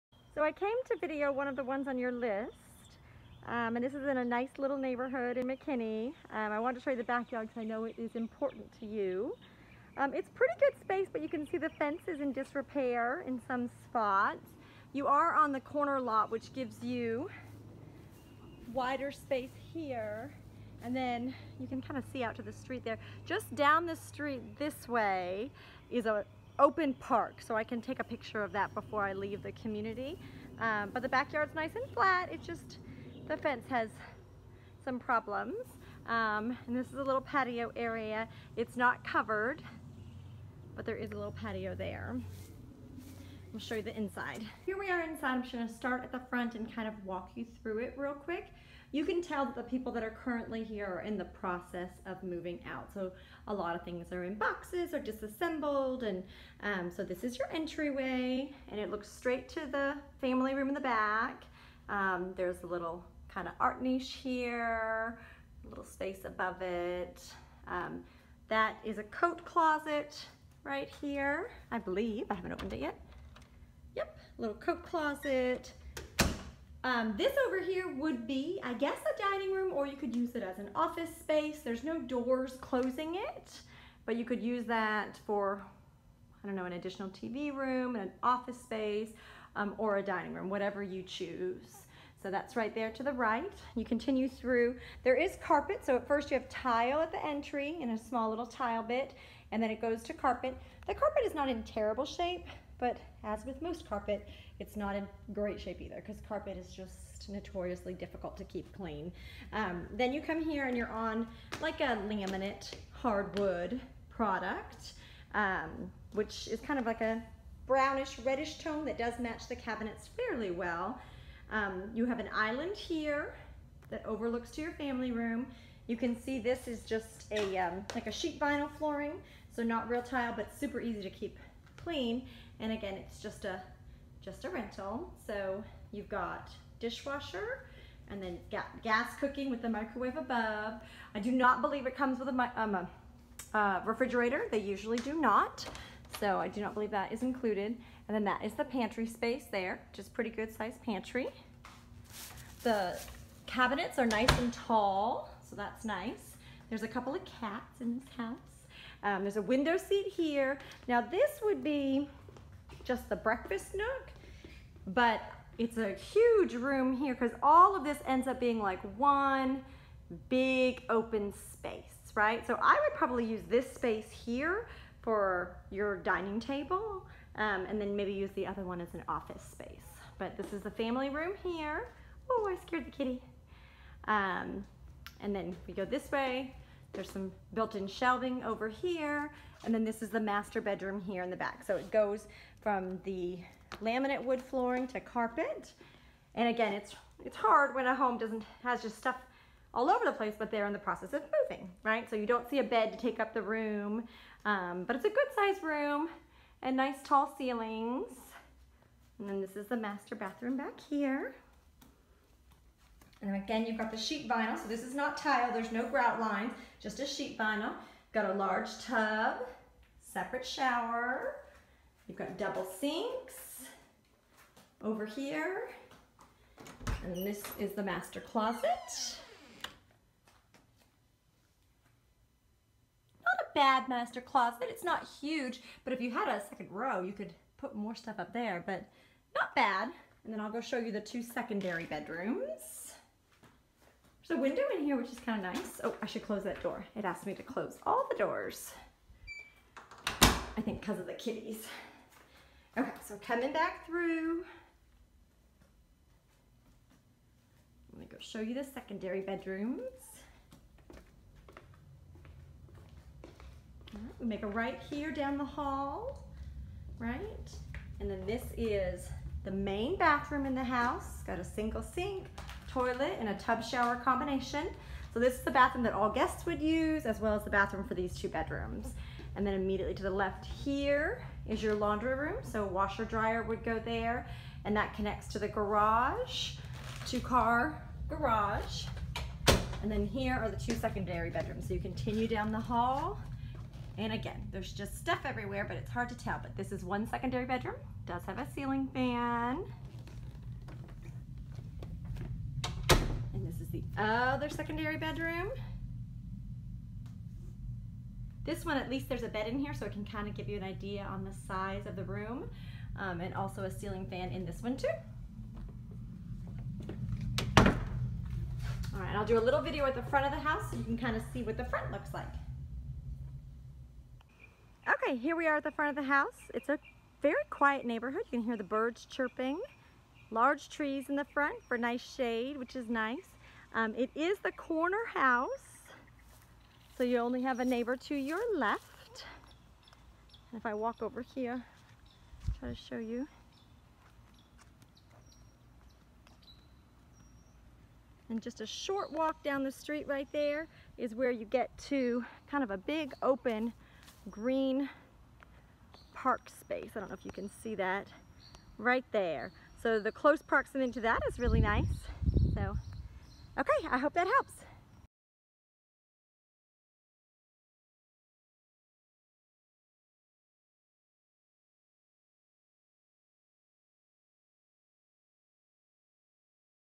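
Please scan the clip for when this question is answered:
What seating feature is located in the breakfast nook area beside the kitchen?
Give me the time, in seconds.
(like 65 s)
159 s.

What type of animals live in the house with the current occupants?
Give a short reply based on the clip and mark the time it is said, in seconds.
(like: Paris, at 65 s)
Cats, at 157 s.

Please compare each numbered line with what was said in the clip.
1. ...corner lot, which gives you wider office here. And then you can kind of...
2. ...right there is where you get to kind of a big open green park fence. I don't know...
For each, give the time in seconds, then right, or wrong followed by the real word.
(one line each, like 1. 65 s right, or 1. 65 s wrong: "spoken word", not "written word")
1. 15 s wrong: "space", not "office"
2. 350 s wrong: "space", not "fence".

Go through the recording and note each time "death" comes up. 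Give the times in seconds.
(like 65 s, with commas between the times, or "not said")
not said.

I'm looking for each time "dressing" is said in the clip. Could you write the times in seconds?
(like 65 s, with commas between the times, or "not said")
not said.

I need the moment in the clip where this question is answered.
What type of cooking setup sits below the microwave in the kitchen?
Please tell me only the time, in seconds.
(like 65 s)
138 s.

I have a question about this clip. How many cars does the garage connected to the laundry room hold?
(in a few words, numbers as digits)
2.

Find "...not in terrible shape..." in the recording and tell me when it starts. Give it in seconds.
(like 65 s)
101 s.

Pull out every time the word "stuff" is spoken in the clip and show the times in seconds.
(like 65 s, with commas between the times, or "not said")
198 s, 237 s, 294 s.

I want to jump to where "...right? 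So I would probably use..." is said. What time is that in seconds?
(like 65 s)
172 s.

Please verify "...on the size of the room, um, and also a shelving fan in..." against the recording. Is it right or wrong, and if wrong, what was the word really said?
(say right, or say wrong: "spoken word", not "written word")
wrong: "ceiling", not "shelving".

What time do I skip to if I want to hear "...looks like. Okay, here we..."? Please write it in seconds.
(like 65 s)
321 s.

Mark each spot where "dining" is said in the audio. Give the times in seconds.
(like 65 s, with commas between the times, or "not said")
79 s, 90 s, 175 s.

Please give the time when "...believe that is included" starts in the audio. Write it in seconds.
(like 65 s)
146 s.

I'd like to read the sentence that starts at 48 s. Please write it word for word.
You can tell that the people that are currently here are in the process of moving out.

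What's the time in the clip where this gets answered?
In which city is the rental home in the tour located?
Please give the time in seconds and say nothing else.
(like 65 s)
5 s.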